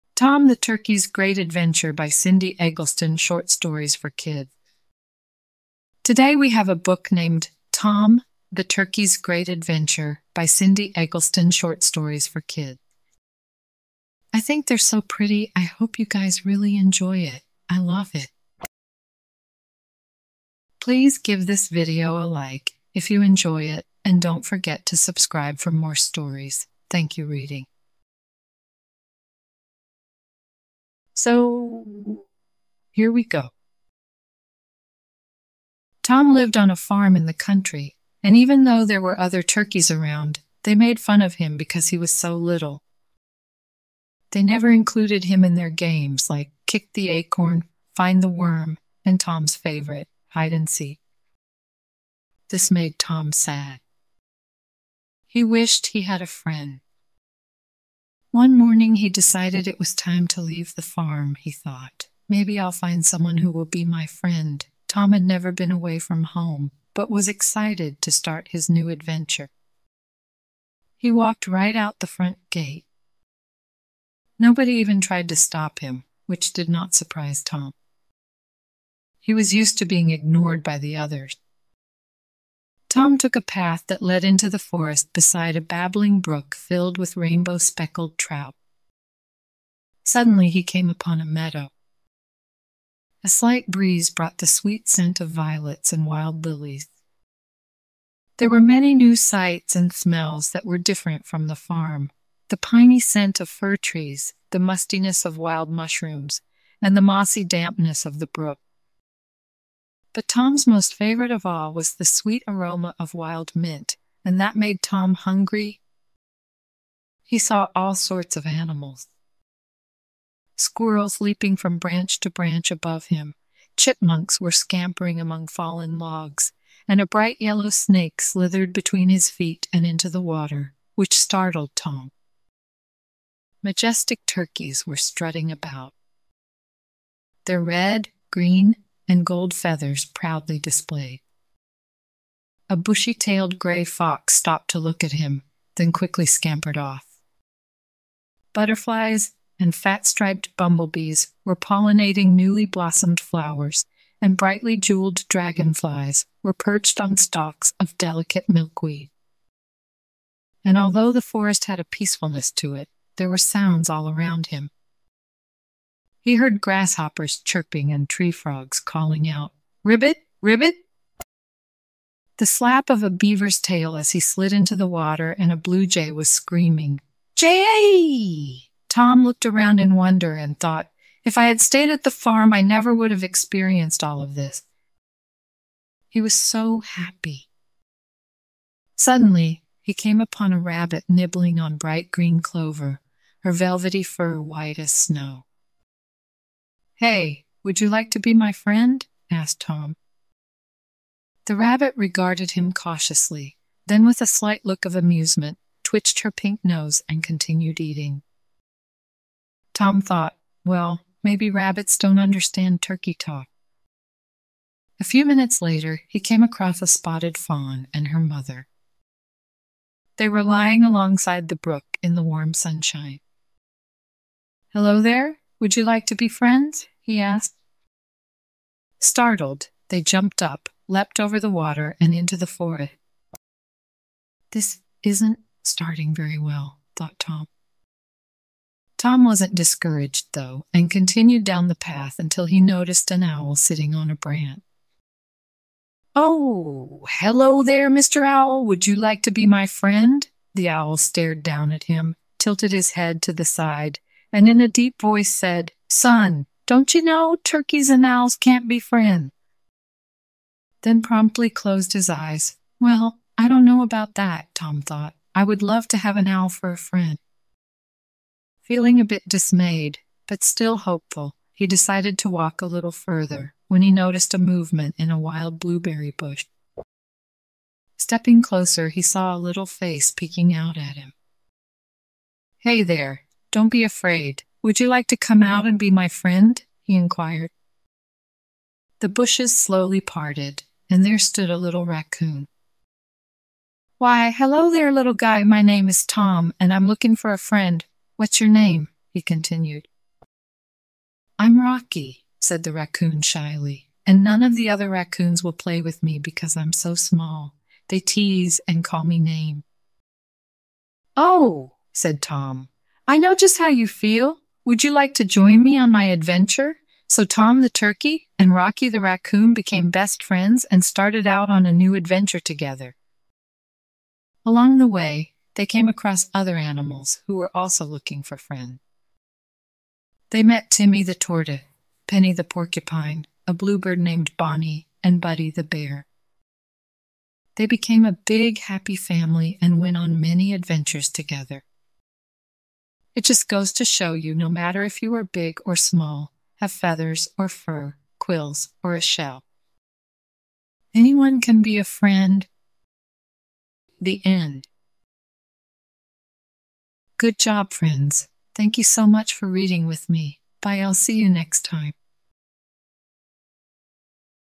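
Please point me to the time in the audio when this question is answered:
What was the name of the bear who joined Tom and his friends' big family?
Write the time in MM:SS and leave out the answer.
05:35.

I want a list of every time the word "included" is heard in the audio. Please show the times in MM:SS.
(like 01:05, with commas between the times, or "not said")
00:44.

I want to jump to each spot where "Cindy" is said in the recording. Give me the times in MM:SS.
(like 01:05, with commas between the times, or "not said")
00:02, 00:10.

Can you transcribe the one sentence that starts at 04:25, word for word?
I would love to have an owl for a friend.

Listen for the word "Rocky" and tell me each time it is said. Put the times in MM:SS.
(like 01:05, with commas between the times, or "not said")
05:01, 05:18.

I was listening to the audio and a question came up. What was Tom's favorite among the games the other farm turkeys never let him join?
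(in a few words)
Hide and seek.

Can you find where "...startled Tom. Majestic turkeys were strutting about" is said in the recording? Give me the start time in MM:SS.
02:11.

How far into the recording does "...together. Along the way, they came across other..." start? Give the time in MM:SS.
05:22.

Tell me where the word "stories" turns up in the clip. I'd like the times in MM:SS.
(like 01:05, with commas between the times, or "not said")
00:03, 00:11, 00:25.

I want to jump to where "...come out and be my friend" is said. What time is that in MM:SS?
04:45.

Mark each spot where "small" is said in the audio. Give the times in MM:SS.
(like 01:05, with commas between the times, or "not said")
05:06, 05:45.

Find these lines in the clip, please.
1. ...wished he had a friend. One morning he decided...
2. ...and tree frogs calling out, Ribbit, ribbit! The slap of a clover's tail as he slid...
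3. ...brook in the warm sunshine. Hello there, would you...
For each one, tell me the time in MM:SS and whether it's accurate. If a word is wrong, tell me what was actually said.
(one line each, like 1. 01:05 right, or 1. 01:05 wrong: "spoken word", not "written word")
1. 00:55 right
2. 02:47 wrong: "beaver", not "clover"
3. 03:41 right.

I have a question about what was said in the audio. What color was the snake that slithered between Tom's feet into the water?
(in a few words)
Bright yellow.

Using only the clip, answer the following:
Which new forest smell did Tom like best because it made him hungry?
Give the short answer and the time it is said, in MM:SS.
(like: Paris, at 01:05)
Wild mint, at 01:53.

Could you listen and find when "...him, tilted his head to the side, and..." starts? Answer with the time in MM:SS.
04:11.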